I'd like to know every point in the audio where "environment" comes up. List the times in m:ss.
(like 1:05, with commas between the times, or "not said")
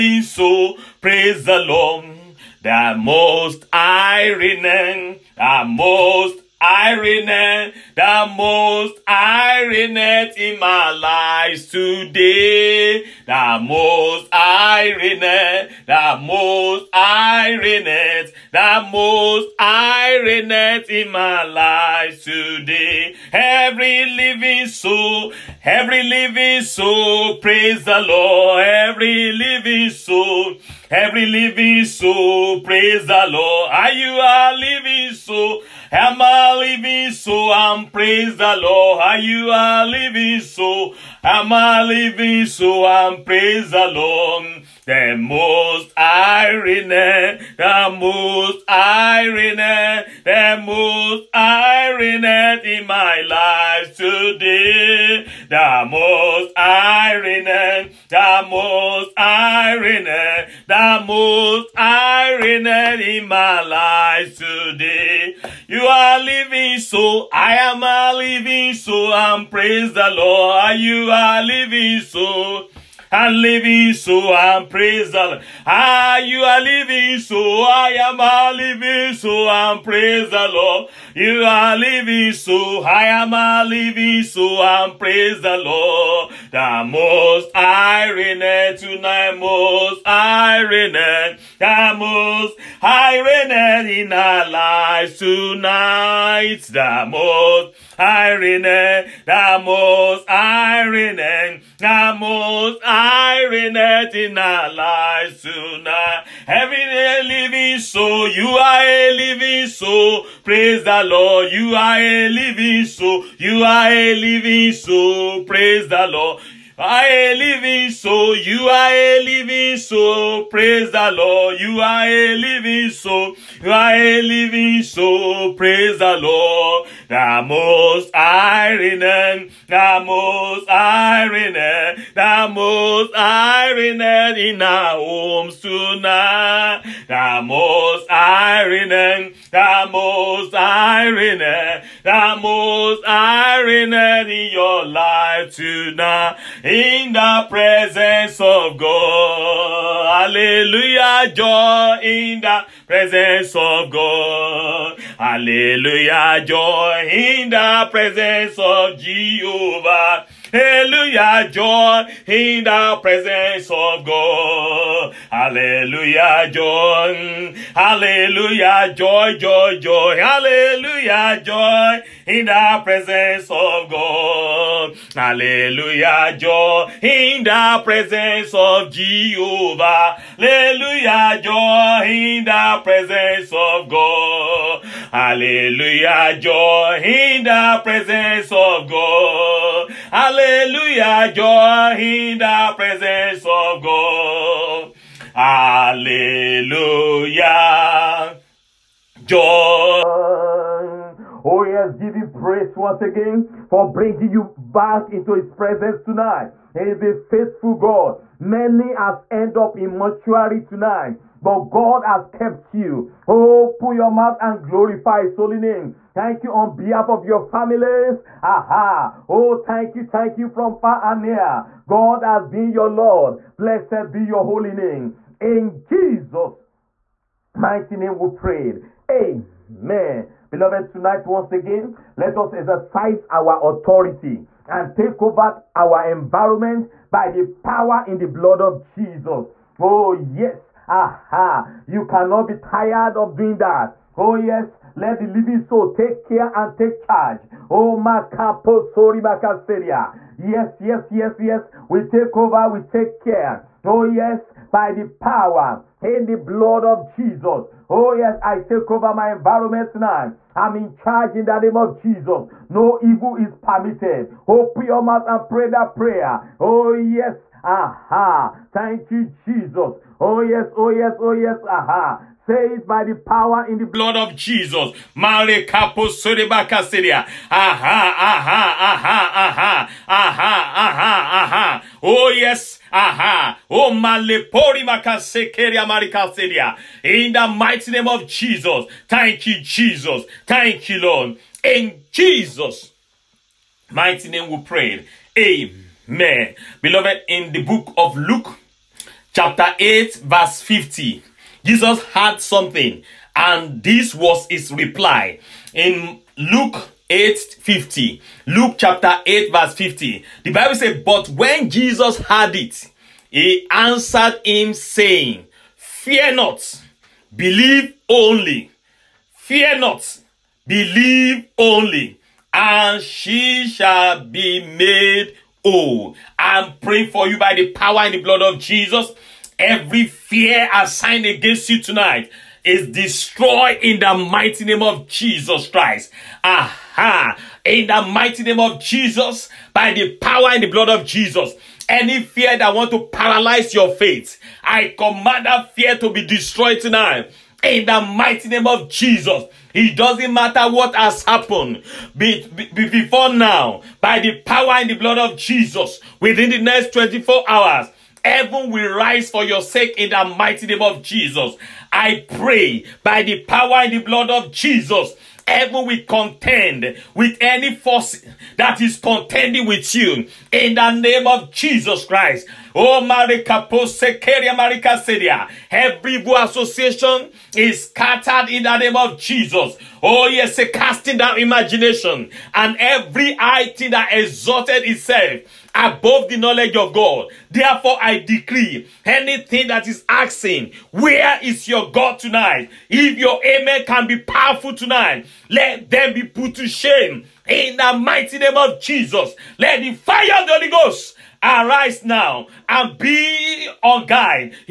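3:56, 4:19.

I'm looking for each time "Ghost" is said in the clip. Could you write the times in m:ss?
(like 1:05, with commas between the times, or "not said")
6:40.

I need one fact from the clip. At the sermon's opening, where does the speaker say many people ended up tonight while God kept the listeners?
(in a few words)
mortuary.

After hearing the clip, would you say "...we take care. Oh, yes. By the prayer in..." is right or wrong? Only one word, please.
wrong.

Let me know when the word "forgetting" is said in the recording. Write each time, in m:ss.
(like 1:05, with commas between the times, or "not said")
not said.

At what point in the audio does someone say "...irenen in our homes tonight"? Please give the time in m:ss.
2:13.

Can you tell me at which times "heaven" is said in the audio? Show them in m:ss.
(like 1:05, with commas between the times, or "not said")
5:58, 6:05.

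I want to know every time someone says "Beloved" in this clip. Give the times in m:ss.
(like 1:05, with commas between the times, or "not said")
3:50, 4:56.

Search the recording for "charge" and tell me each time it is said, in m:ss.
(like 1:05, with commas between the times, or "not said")
4:07, 4:20.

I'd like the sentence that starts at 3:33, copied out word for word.
Oh, put your mouth and glorify his holy name.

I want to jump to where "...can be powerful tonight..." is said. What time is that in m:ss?
6:33.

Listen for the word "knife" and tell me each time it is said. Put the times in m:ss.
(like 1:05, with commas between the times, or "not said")
not said.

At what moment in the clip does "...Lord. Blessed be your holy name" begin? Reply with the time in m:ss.
3:42.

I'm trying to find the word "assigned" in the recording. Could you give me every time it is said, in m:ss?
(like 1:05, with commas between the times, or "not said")
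5:30.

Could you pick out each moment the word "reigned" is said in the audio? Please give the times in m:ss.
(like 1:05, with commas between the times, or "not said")
1:33, 1:43.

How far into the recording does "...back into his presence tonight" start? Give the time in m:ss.
3:24.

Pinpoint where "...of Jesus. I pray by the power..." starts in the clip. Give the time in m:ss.
6:00.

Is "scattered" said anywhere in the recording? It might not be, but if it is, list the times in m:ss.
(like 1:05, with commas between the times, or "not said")
6:17.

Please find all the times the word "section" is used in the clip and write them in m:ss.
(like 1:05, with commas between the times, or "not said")
not said.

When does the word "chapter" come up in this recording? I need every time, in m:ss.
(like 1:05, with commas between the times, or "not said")
4:59, 5:08.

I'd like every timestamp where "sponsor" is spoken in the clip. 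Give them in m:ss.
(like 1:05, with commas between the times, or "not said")
not said.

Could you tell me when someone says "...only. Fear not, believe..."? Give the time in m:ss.
5:18.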